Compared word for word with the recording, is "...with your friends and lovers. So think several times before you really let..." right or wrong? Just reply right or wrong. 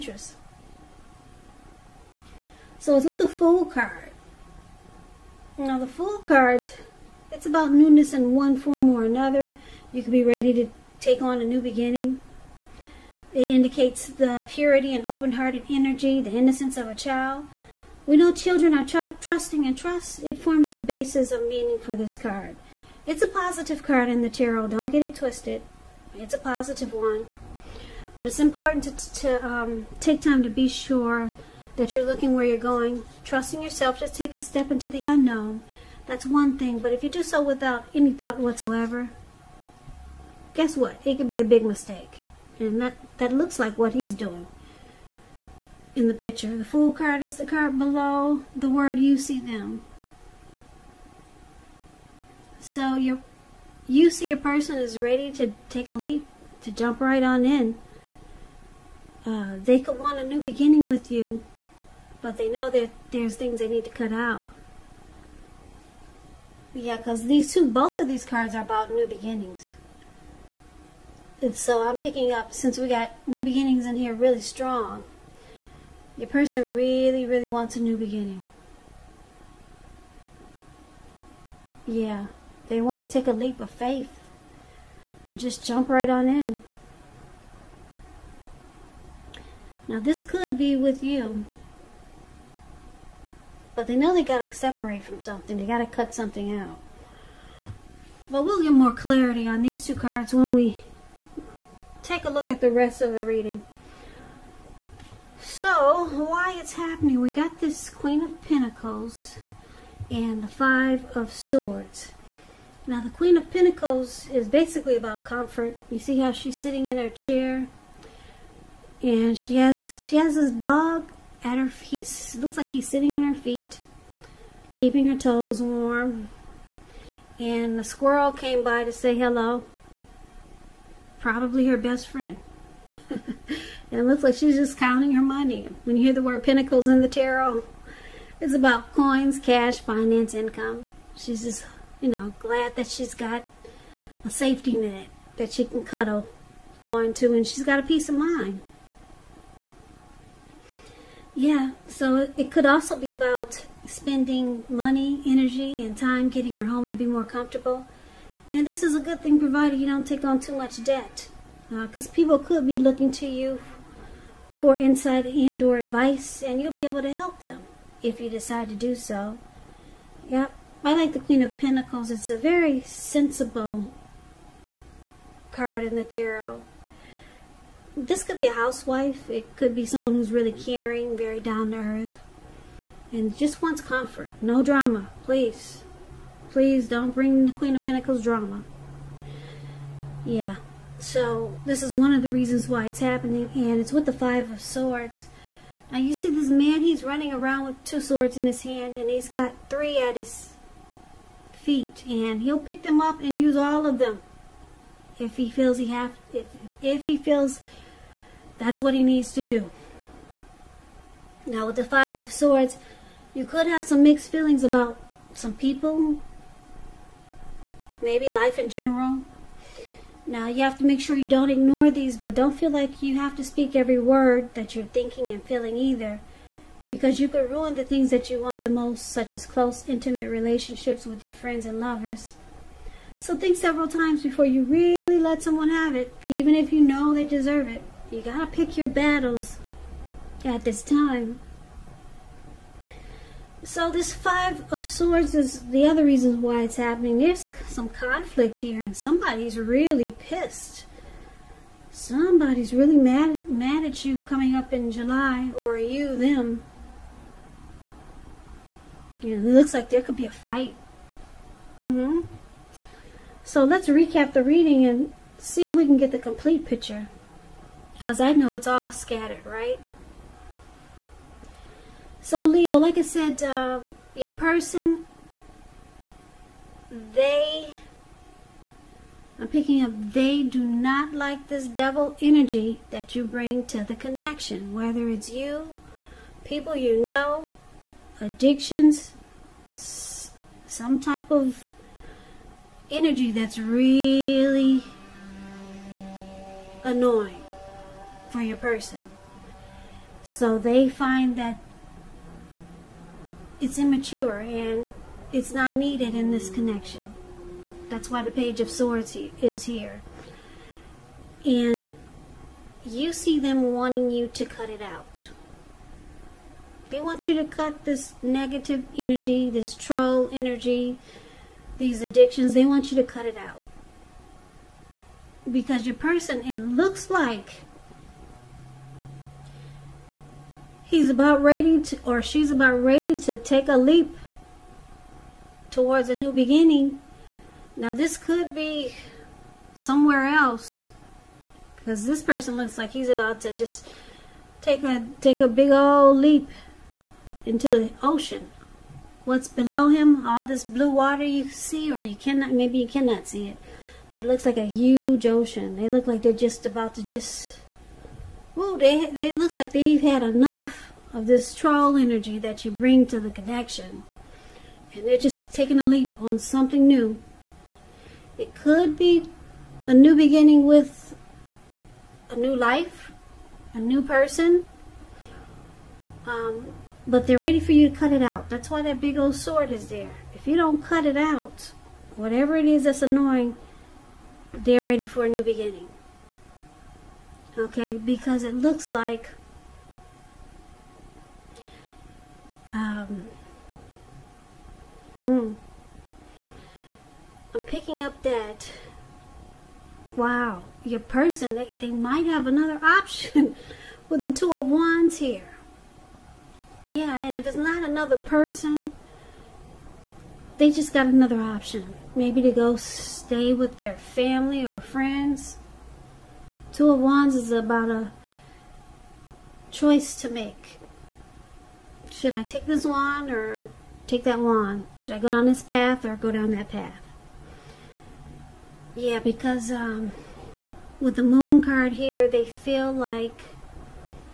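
right.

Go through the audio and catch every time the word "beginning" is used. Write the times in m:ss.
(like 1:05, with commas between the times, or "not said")
0:11, 1:00, 1:09, 1:13, 1:17, 5:36, 6:10, 6:25.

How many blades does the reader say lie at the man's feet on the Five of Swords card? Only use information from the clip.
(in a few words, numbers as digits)
3.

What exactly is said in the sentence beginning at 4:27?
Because I know it's all scattered, right?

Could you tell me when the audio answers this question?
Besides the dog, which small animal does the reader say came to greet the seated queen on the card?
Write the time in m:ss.
2:07.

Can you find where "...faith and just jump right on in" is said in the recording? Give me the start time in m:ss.
1:23.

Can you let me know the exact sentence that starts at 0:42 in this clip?
And that, that looks like what he's doing in the picture.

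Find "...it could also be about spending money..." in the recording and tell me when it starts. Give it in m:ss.
2:32.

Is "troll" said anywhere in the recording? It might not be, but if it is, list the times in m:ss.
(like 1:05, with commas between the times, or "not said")
5:19, 6:01.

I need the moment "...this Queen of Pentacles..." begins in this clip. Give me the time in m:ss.
1:47.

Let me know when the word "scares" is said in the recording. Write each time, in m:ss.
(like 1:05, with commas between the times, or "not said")
not said.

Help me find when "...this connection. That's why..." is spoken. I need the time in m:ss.
5:06.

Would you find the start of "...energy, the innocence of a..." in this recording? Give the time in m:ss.
0:15.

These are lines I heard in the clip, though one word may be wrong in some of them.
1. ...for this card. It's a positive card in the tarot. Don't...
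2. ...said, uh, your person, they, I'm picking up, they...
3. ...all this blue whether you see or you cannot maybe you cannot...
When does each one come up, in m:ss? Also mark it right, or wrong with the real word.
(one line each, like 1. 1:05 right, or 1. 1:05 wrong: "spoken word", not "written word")
1. 0:21 right
2. 4:33 right
3. 5:50 wrong: "water", not "whether".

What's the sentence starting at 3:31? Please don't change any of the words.
Now with the Five of Swords, you could have some mixed feelings about some people, maybe life in general.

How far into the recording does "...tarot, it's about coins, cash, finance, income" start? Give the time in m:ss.
2:17.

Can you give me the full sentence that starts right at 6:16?
Um, but they're ready for you to cut it out.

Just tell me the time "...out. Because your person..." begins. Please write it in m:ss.
5:23.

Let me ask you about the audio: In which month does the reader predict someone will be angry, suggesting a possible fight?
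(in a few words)
July.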